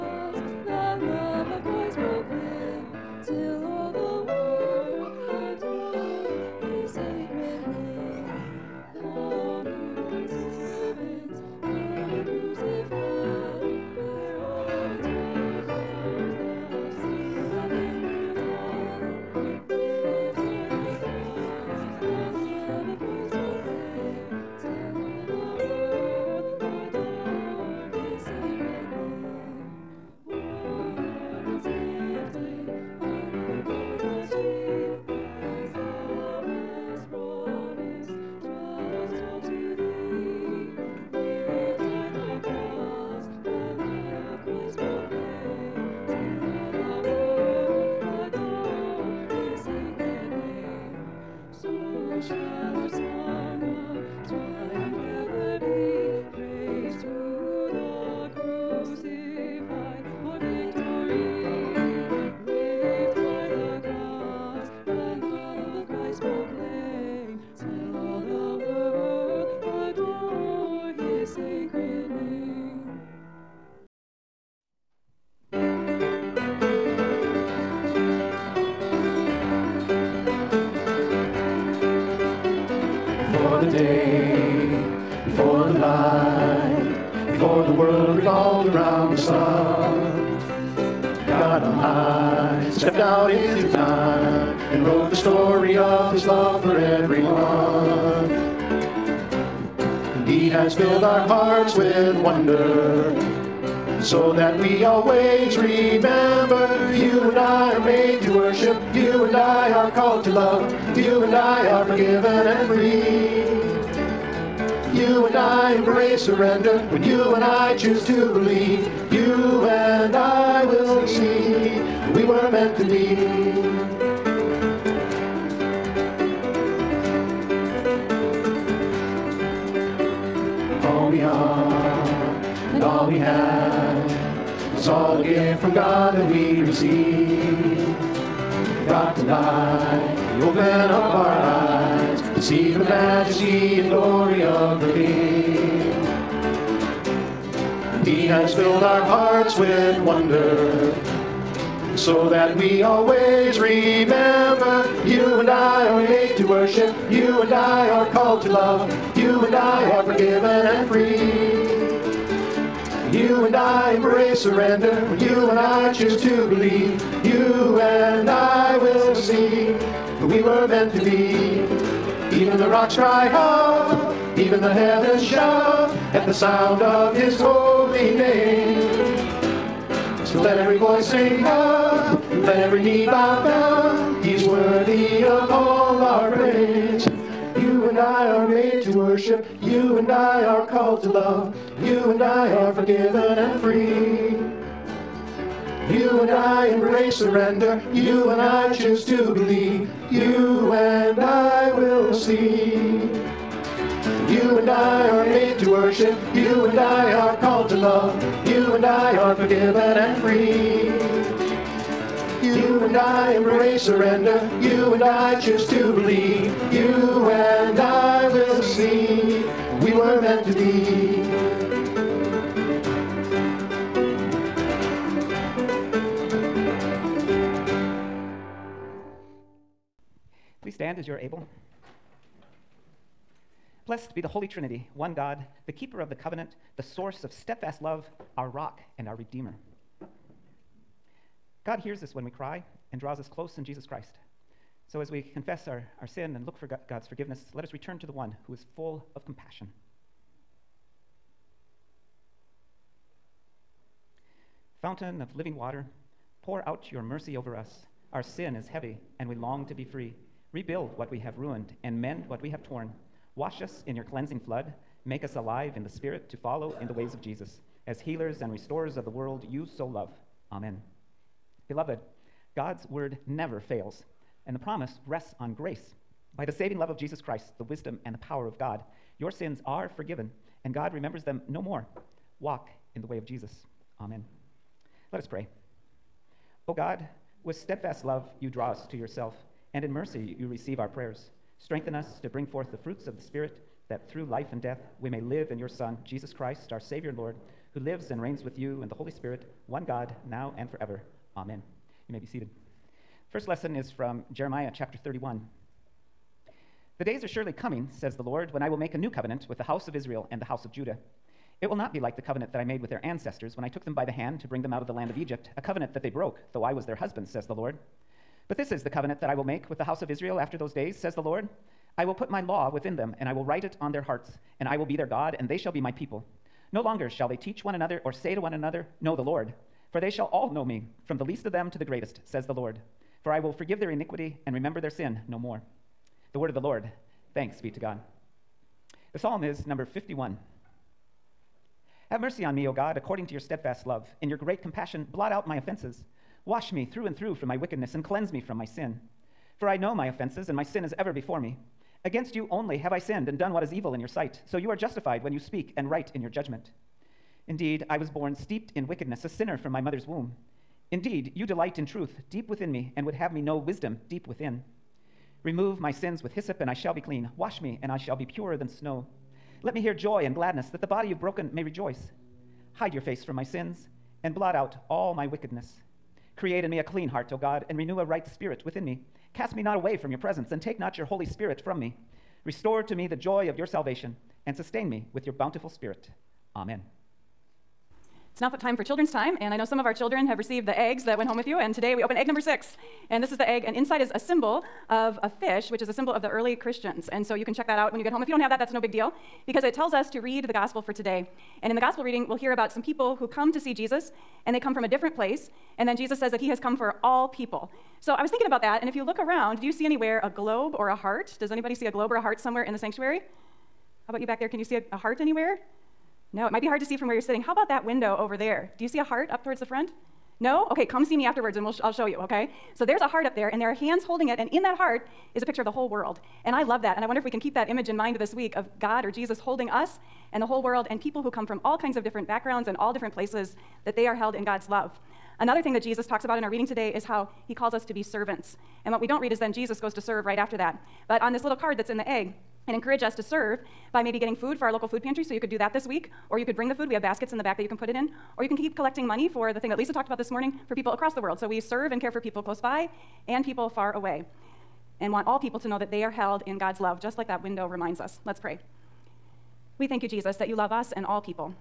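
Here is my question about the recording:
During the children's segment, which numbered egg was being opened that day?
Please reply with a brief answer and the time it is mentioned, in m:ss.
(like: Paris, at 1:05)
Six, at 6:32.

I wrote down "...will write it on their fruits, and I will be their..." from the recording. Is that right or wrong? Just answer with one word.
wrong.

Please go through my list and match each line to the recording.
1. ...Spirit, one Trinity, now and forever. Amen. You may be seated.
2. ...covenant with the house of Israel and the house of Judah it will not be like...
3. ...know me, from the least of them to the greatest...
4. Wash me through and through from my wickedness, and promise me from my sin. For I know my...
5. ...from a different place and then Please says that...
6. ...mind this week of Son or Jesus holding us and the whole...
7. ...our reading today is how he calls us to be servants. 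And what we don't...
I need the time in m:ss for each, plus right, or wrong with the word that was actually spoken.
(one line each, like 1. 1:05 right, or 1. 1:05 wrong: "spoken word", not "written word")
1. 4:59 wrong: "God", not "Trinity"
2. 5:09 right
3. 5:30 right
4. 5:46 wrong: "cleanse", not "promise"
5. 6:44 wrong: "Jesus", not "Please"
6. 7:07 wrong: "God", not "Son"
7. 7:16 right.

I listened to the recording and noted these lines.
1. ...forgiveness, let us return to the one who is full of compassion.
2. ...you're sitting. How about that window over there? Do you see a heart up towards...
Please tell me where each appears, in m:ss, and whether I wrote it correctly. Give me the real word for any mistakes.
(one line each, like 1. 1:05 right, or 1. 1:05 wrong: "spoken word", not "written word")
1. 4:07 right
2. 6:57 right.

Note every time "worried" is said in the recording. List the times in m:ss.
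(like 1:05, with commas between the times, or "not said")
not said.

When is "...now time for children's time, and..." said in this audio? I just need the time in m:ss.
6:28.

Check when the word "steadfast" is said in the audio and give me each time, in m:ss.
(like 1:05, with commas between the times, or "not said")
3:57, 4:47, 5:43.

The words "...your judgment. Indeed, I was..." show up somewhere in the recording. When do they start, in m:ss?
5:56.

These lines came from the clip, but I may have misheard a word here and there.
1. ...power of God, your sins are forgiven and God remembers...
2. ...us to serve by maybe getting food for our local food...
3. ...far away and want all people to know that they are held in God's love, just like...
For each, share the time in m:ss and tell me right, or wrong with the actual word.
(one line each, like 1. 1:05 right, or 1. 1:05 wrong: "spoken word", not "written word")
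1. 4:38 right
2. 7:23 right
3. 7:33 right.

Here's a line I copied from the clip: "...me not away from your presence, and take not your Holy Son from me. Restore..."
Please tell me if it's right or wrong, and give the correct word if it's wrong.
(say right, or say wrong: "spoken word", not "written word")
wrong: "Spirit", not "Son".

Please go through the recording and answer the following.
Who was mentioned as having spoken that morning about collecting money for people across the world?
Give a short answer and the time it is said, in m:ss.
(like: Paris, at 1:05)
Lisa, at 7:29.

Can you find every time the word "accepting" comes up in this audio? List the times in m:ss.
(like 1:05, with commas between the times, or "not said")
not said.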